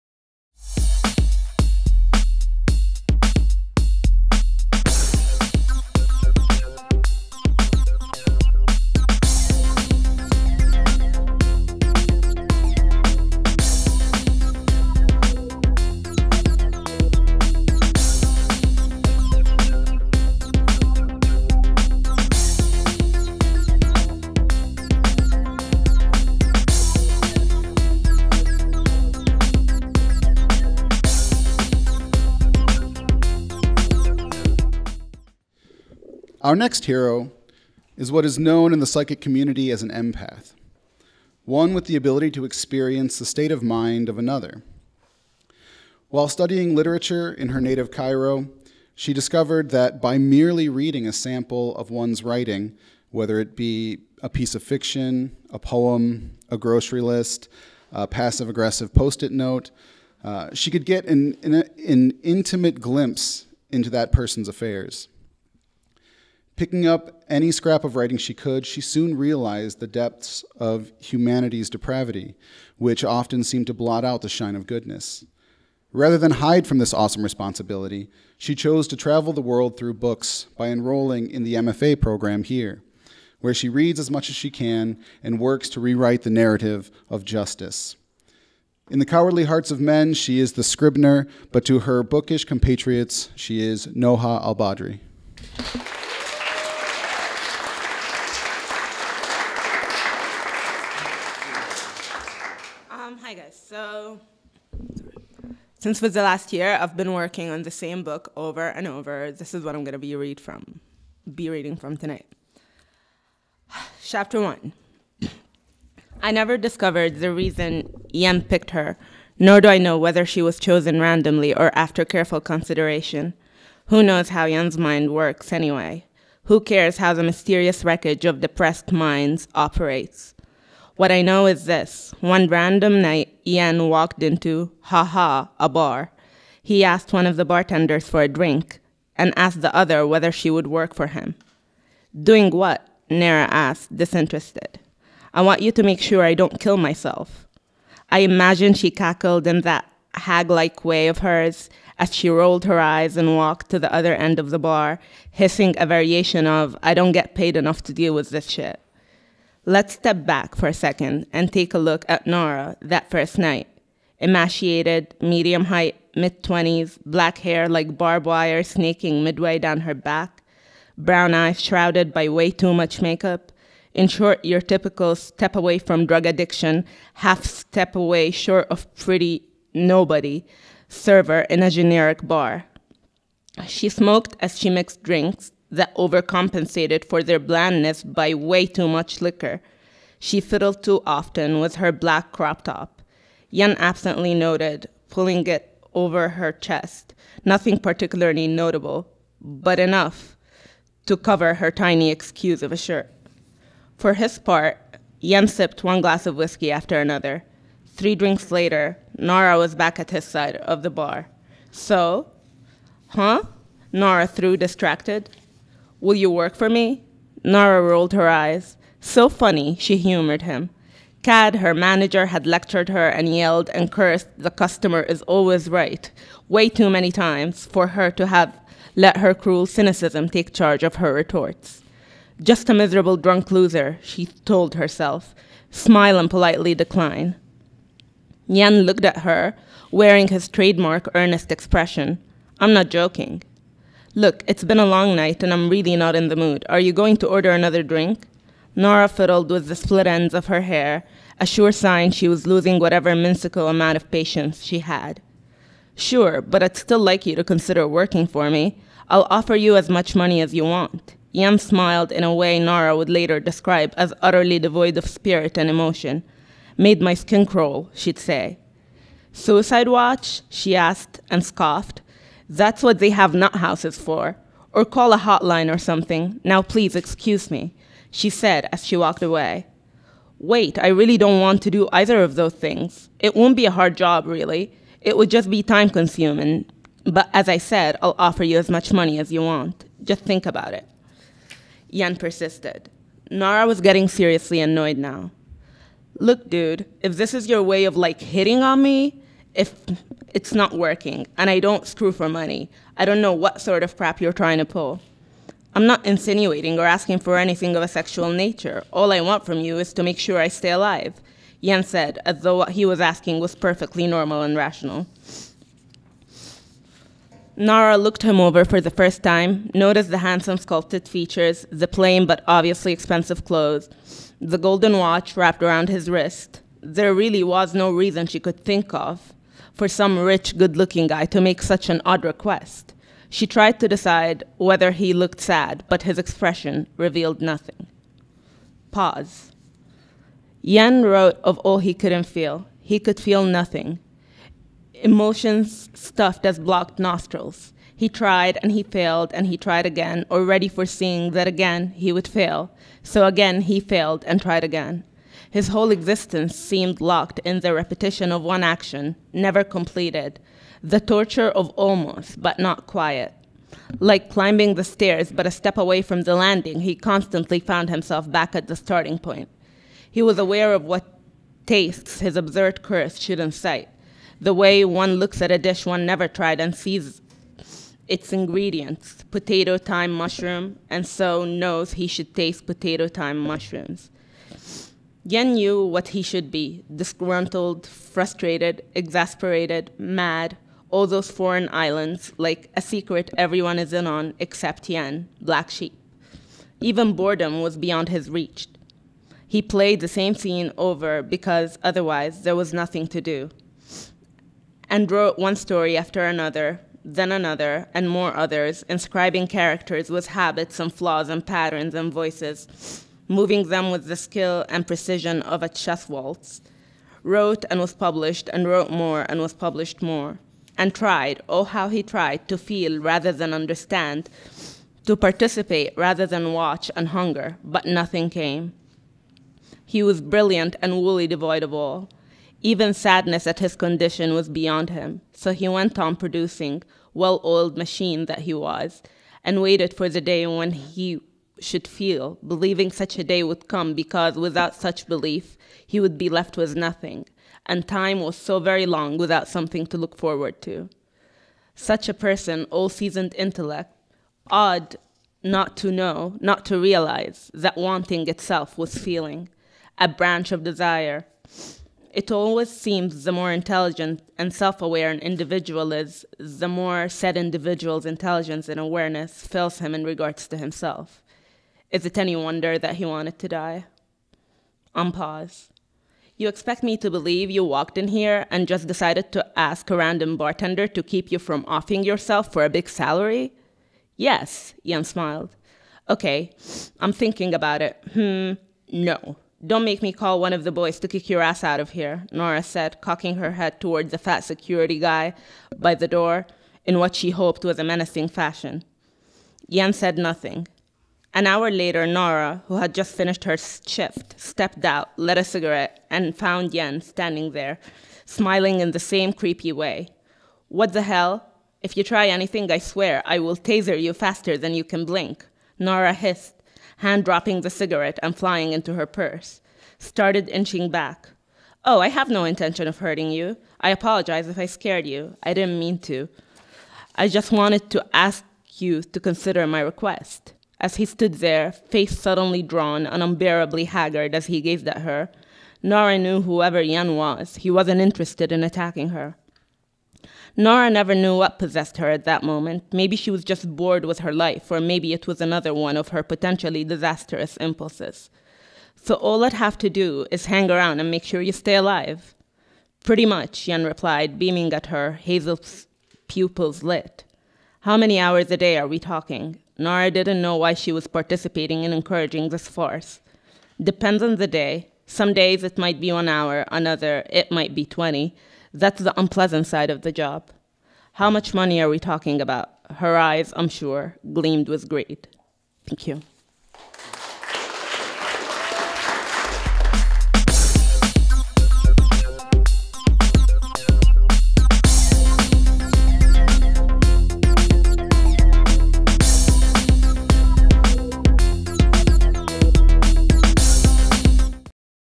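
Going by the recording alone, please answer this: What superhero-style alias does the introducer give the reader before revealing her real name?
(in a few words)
the Scribner.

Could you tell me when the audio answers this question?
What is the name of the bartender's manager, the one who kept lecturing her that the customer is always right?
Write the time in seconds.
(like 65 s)
221 s.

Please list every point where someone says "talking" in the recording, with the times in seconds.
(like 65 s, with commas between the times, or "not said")
558 s, 571 s.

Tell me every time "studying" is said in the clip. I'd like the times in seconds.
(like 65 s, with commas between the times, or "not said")
46 s.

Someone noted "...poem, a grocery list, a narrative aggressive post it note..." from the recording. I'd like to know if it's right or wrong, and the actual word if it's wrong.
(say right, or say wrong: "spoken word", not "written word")
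wrong: "passive", not "narrative".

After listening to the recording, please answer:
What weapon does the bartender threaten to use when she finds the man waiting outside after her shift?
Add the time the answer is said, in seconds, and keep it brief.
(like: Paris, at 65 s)
taser, at 513 s.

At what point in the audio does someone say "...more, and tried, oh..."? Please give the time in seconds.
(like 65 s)
420 s.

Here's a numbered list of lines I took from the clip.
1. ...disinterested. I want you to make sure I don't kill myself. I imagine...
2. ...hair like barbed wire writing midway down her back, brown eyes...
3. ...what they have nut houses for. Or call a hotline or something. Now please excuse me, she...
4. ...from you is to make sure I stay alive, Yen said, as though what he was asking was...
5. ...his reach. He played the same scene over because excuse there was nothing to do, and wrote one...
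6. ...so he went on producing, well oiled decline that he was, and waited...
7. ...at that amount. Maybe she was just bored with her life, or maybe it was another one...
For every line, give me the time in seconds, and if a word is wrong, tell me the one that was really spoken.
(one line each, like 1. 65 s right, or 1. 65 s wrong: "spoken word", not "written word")
1. 143 s right
2. 167 s wrong: "snaking", not "writing"
3. 272 s right
4. 309 s right
5. 398 s wrong: "otherwise", not "excuse"
6. 435 s wrong: "machine", not "decline"
7. 542 s wrong: "moment", not "amount".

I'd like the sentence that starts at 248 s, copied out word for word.
Nora fiddled with the split ends of her hair, a sure sign she was losing whatever minuscule amount of patience she had.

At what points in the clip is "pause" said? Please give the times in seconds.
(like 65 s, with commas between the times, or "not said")
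338 s, 475 s.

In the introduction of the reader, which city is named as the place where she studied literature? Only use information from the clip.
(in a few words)
Cairo.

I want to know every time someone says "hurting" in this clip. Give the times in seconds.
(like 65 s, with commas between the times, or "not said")
522 s.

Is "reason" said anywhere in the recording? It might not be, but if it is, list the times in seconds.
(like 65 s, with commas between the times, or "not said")
117 s, 327 s.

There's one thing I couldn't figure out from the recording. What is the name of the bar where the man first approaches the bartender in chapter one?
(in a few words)
Ha Ha.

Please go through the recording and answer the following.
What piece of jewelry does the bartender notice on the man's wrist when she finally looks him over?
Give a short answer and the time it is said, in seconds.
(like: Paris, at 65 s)
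golden watch, at 324 s.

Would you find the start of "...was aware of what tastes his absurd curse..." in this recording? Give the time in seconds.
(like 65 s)
370 s.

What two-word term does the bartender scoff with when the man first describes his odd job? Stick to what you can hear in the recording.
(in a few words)
Suicide watch.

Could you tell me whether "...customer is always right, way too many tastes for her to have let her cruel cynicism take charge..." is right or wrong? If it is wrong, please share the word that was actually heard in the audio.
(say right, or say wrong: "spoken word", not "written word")
wrong: "times", not "tastes".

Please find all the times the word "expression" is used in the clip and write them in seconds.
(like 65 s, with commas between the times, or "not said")
241 s, 336 s.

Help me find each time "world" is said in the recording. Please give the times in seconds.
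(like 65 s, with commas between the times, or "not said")
79 s.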